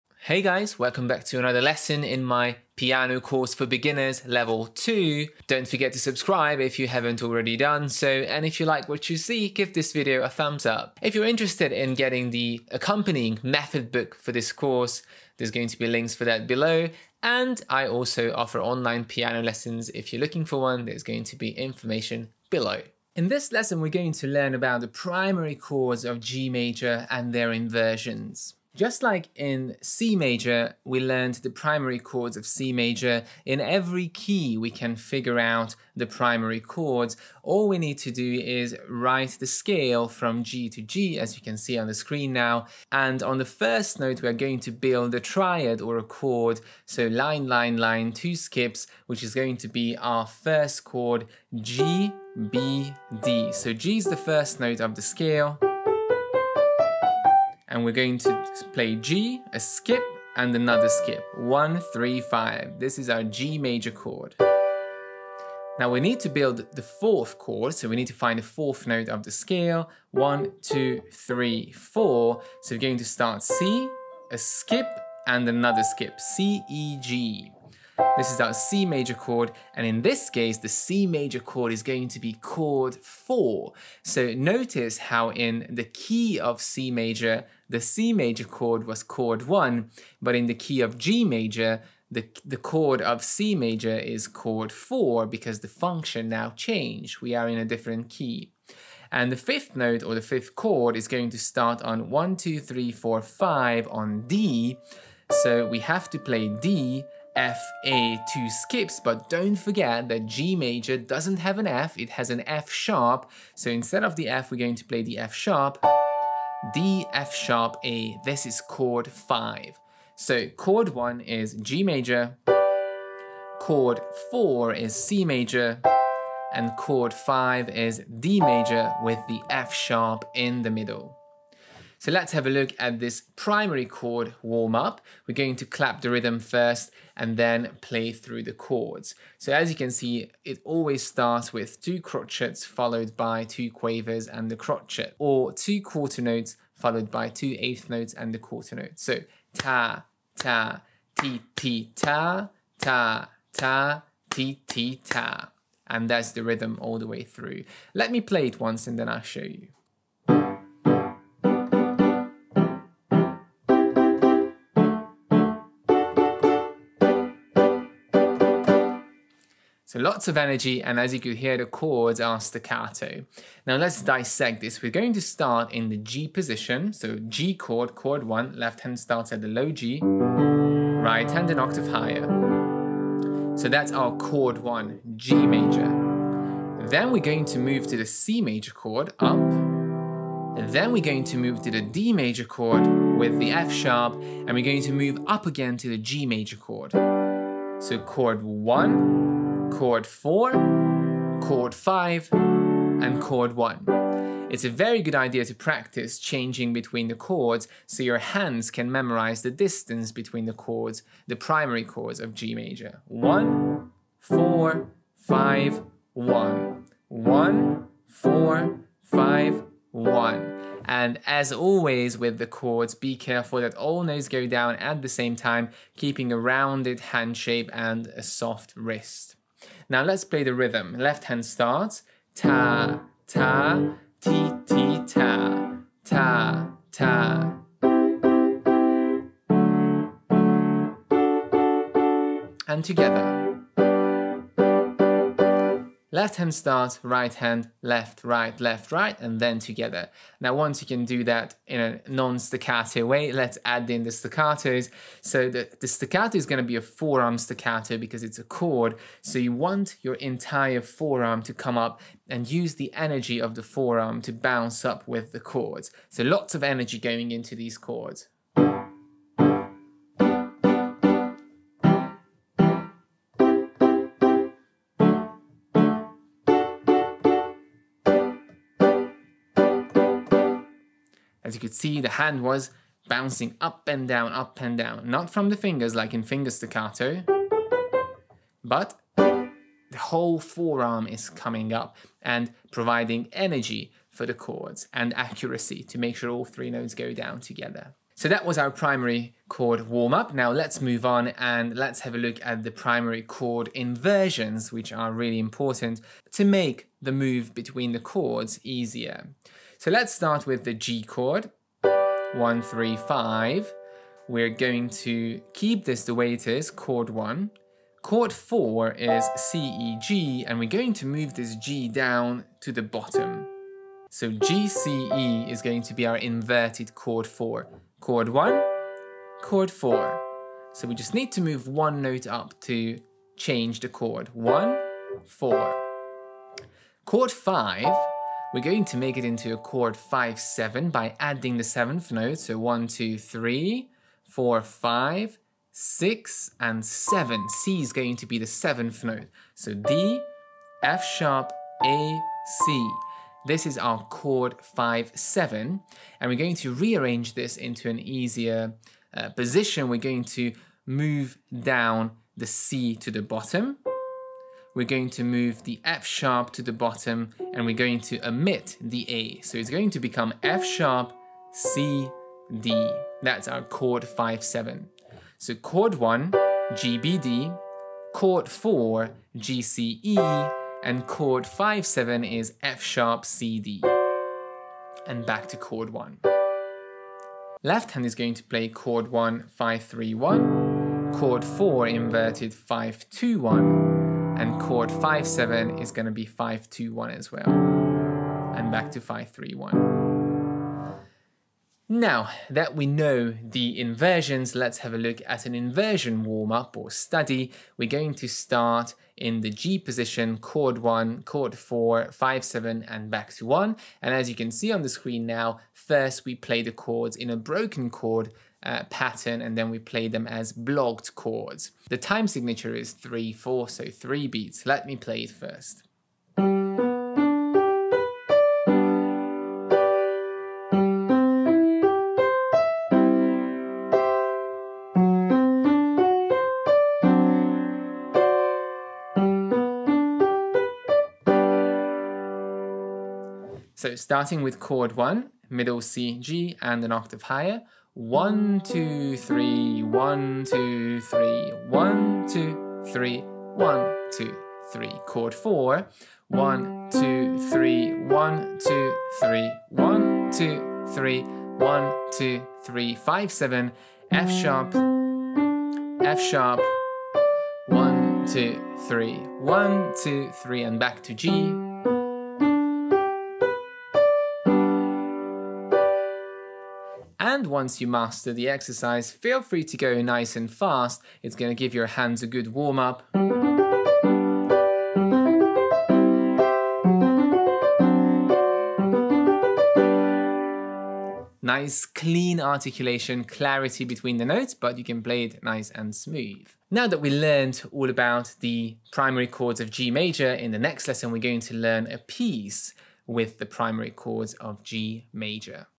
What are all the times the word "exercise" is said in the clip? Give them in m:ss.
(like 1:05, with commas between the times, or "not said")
7:58.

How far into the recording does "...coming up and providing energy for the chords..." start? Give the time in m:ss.
4:51.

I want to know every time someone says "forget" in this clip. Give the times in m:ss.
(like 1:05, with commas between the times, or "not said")
0:05, 1:49.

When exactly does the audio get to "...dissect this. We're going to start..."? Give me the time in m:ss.
2:54.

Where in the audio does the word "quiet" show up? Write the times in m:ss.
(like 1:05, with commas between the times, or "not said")
not said.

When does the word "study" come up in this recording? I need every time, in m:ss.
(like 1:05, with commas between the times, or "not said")
6:46.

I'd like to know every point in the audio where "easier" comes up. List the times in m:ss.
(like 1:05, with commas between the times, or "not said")
5:08, 5:57.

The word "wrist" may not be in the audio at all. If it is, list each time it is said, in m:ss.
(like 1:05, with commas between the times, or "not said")
3:48.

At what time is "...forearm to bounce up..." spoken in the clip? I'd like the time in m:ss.
4:23.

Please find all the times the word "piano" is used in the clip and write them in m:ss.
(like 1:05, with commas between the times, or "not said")
0:02, 0:19.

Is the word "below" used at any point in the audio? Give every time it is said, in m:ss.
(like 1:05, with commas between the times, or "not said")
0:16, 0:22.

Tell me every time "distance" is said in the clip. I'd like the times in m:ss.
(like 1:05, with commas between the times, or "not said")
3:29.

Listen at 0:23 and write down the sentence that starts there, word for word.
In this lesson we're going to learn about the primary chords of G major and their inversions.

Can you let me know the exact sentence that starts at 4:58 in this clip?
So that was our primary chord warm up.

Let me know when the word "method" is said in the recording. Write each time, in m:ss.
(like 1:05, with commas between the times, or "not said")
0:13.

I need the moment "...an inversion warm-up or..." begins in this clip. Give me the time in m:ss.
6:45.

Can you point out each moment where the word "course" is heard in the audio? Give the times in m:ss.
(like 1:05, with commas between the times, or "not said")
0:03, 0:14.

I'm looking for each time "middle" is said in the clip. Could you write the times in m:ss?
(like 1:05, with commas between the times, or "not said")
2:10, 7:25.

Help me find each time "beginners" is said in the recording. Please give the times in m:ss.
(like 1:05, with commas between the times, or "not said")
0:03.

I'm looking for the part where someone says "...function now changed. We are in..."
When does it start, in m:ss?
1:35.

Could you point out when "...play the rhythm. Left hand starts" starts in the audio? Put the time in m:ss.
3:50.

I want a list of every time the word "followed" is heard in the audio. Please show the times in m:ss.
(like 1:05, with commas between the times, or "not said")
2:22, 2:26.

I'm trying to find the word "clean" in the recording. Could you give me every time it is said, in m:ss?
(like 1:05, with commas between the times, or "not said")
8:11.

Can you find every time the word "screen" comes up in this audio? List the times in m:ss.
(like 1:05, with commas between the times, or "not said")
0:41, 6:54.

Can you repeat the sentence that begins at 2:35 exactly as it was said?
And that's the rhythm all the way through.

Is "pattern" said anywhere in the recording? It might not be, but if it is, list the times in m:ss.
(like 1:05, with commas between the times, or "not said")
6:58.